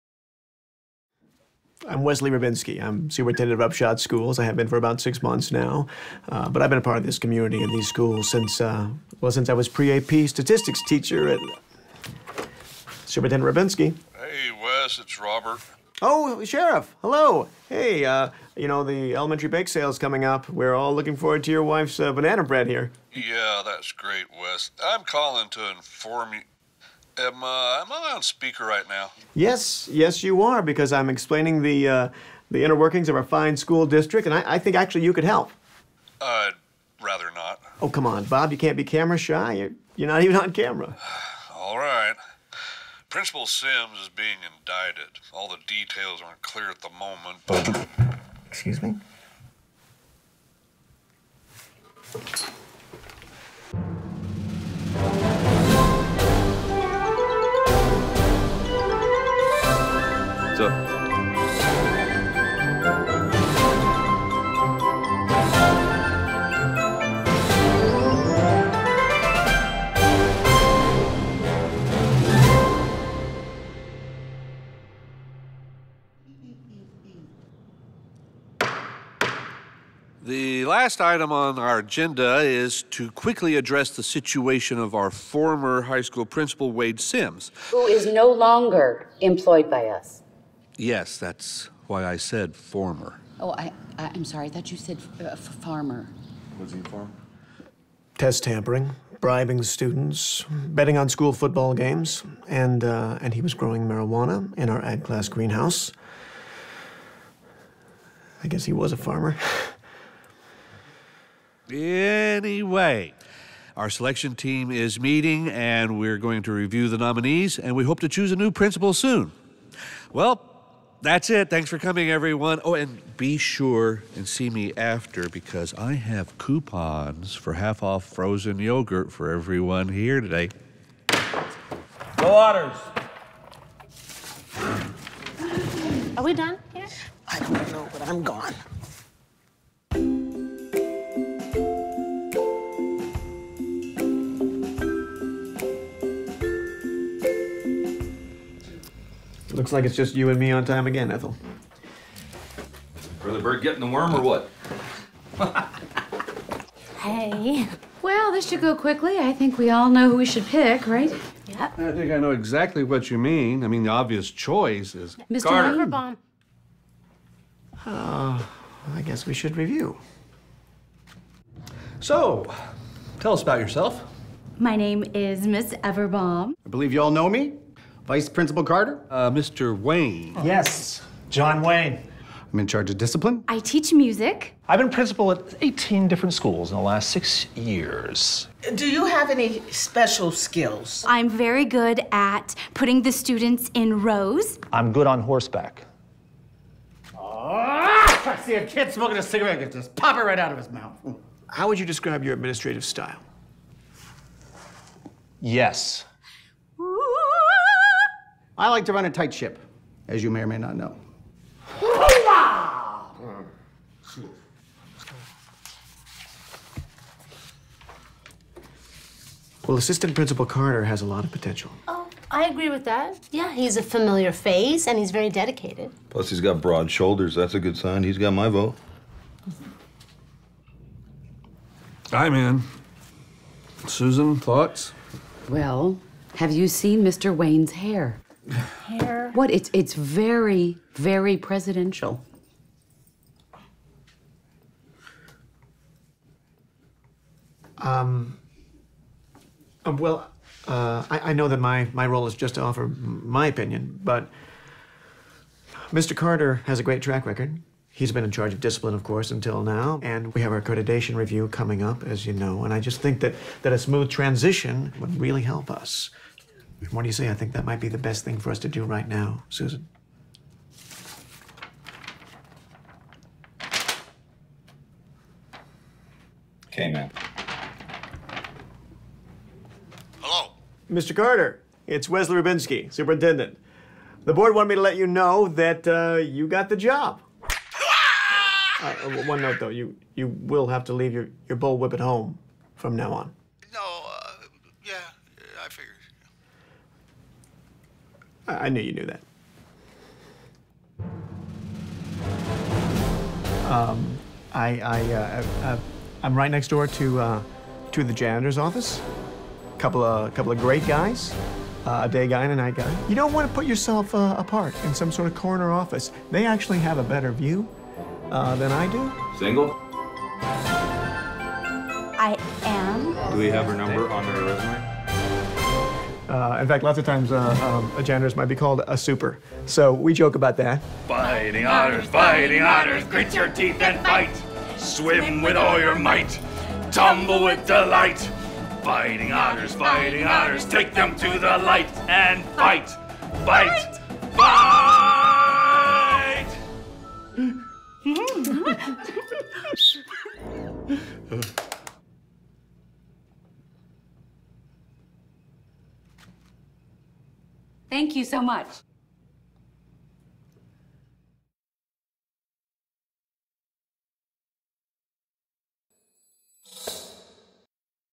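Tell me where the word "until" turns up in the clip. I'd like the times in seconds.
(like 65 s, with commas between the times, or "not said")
259 s.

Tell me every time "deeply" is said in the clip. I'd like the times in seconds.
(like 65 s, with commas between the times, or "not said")
not said.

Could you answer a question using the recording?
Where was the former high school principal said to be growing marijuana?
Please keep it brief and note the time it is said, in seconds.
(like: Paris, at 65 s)
ag class greenhouse, at 104 s.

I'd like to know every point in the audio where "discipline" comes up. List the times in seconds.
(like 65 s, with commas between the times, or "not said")
182 s, 258 s.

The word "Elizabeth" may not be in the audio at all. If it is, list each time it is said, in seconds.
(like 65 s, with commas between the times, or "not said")
not said.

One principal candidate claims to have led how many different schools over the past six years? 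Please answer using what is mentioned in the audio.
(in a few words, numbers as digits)
18.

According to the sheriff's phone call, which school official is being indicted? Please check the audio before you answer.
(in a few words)
Principal Simms.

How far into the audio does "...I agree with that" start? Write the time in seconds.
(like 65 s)
222 s.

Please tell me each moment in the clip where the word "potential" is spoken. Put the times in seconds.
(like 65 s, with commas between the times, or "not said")
221 s.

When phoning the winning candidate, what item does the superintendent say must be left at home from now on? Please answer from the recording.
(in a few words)
bullwhip.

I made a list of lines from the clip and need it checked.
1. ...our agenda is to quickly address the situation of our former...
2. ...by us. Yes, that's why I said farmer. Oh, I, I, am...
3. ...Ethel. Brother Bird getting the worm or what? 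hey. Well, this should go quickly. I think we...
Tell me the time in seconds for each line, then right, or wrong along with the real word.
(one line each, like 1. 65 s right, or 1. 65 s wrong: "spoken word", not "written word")
1. 81 s right
2. 89 s wrong: "former", not "farmer"
3. 151 s right.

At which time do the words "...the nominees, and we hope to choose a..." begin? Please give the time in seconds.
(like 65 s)
116 s.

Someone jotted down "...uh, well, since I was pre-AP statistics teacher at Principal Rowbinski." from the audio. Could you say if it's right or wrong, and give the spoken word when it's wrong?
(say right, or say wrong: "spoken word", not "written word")
wrong: "Superintendent", not "Principal".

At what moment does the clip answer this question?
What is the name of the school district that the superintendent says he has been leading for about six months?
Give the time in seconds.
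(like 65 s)
3 s.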